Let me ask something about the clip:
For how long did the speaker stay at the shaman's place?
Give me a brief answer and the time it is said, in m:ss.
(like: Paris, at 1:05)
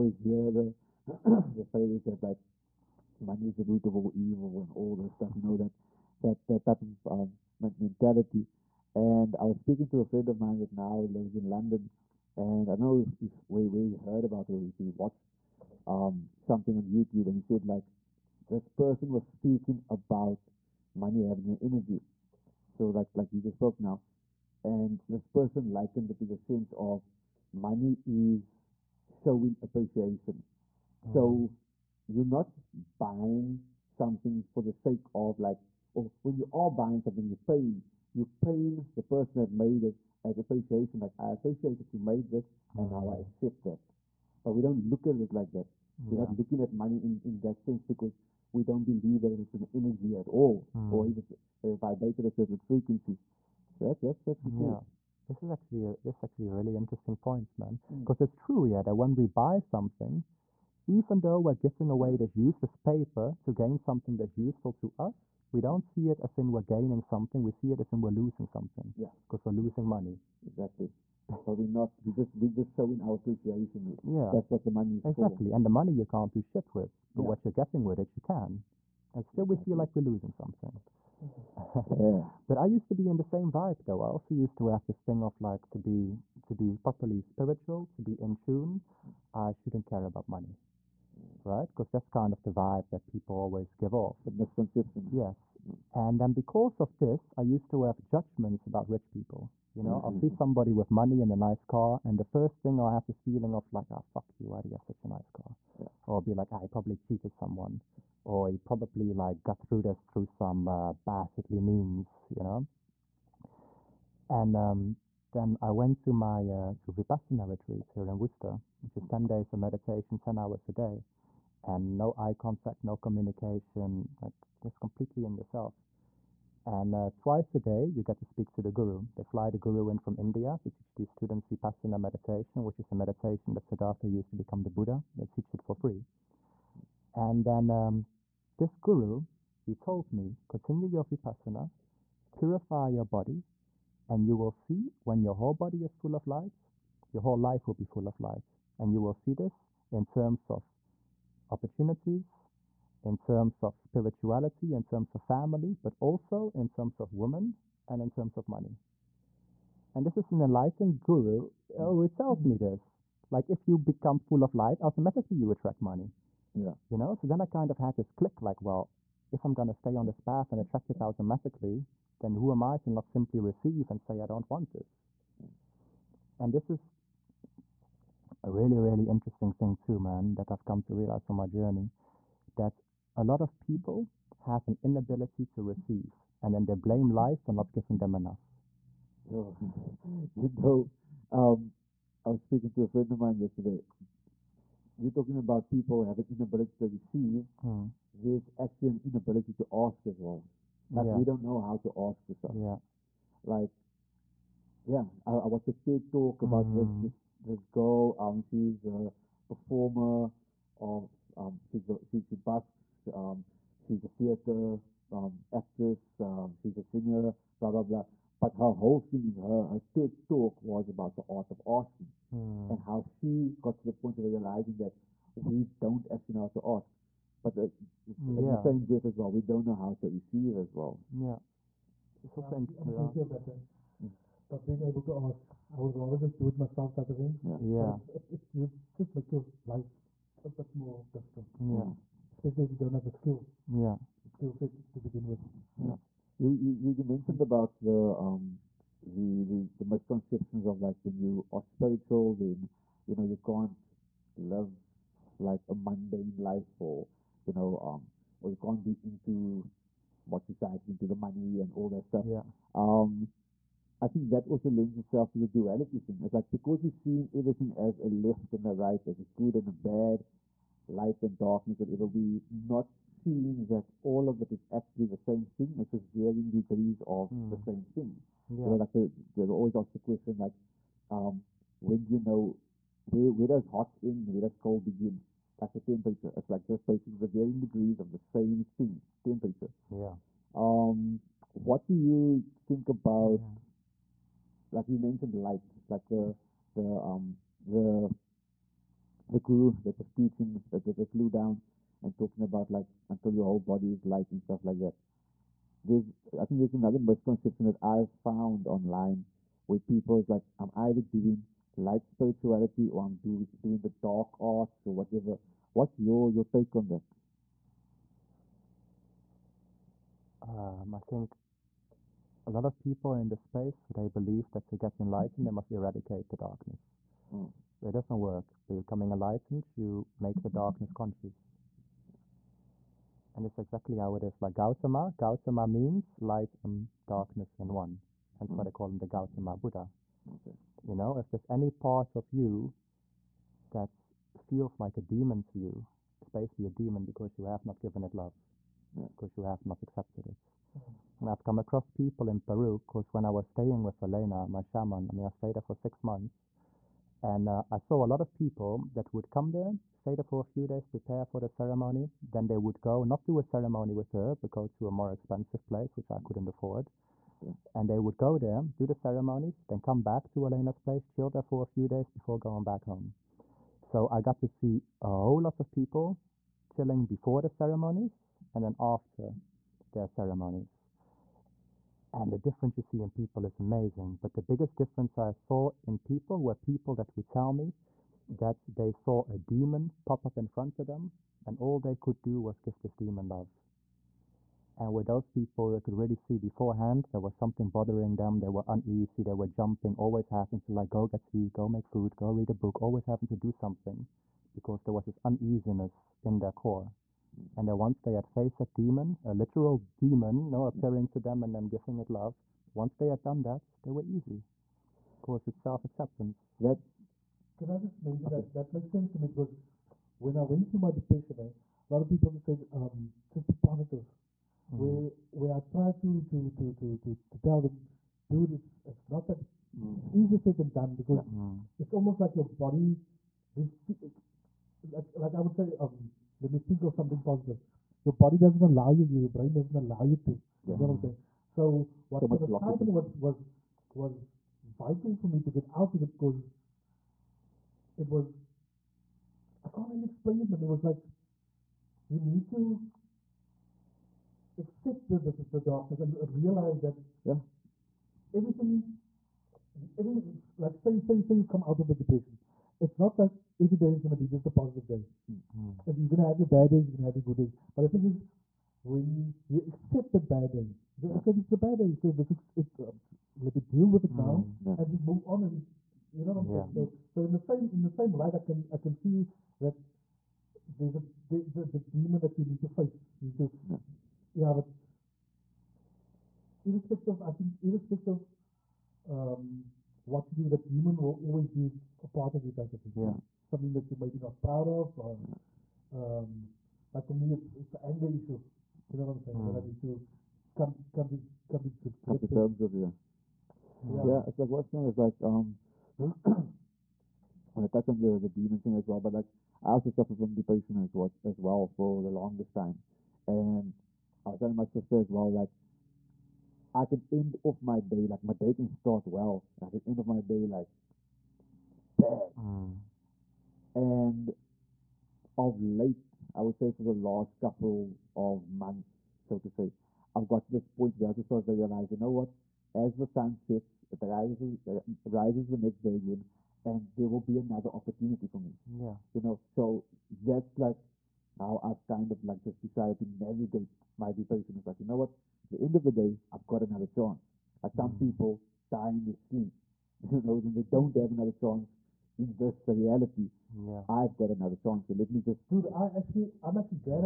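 6 months, at 5:55.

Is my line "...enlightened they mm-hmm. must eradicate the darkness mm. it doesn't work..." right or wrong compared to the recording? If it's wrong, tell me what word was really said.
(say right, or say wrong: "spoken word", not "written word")
right.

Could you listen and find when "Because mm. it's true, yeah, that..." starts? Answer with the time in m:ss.
0:57.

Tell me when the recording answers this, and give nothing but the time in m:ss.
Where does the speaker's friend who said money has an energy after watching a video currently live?
0:11.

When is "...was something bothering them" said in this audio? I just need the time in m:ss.
6:37.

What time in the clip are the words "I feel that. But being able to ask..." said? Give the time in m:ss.
3:52.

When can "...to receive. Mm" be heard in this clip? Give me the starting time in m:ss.
3:16.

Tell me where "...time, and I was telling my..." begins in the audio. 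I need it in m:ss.
8:32.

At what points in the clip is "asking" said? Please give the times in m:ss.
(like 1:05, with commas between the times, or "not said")
3:41.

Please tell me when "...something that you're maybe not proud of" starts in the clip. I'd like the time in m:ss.
8:13.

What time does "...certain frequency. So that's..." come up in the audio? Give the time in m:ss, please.
0:52.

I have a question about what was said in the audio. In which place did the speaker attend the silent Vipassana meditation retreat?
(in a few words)
Worcester.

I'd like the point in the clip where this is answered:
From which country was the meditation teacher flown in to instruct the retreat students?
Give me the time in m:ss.
2:10.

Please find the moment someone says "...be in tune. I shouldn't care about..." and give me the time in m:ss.
1:28.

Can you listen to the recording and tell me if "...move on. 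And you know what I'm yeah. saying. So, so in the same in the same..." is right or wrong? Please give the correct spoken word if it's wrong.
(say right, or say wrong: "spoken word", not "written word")
right.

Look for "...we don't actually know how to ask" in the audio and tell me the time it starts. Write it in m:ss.
3:45.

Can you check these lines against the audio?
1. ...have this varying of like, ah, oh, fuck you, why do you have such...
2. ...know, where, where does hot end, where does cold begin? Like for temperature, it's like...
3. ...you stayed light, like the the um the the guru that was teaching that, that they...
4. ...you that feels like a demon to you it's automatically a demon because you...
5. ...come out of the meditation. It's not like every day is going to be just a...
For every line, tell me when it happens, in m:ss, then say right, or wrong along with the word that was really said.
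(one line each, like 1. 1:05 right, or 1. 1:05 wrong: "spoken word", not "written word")
1. 1:42 wrong: "feeling", not "varying"
2. 4:42 right
3. 4:54 wrong: "mentioned", not "stayed"
4. 5:42 wrong: "basically", not "automatically"
5. 7:41 wrong: "depression", not "meditation".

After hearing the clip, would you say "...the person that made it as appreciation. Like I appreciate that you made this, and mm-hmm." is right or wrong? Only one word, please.
right.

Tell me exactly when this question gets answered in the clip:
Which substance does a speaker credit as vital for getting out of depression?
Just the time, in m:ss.
7:22.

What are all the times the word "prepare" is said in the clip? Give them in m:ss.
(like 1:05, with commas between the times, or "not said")
6:00.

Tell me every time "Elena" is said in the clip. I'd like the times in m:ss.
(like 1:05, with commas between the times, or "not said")
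5:54, 6:10.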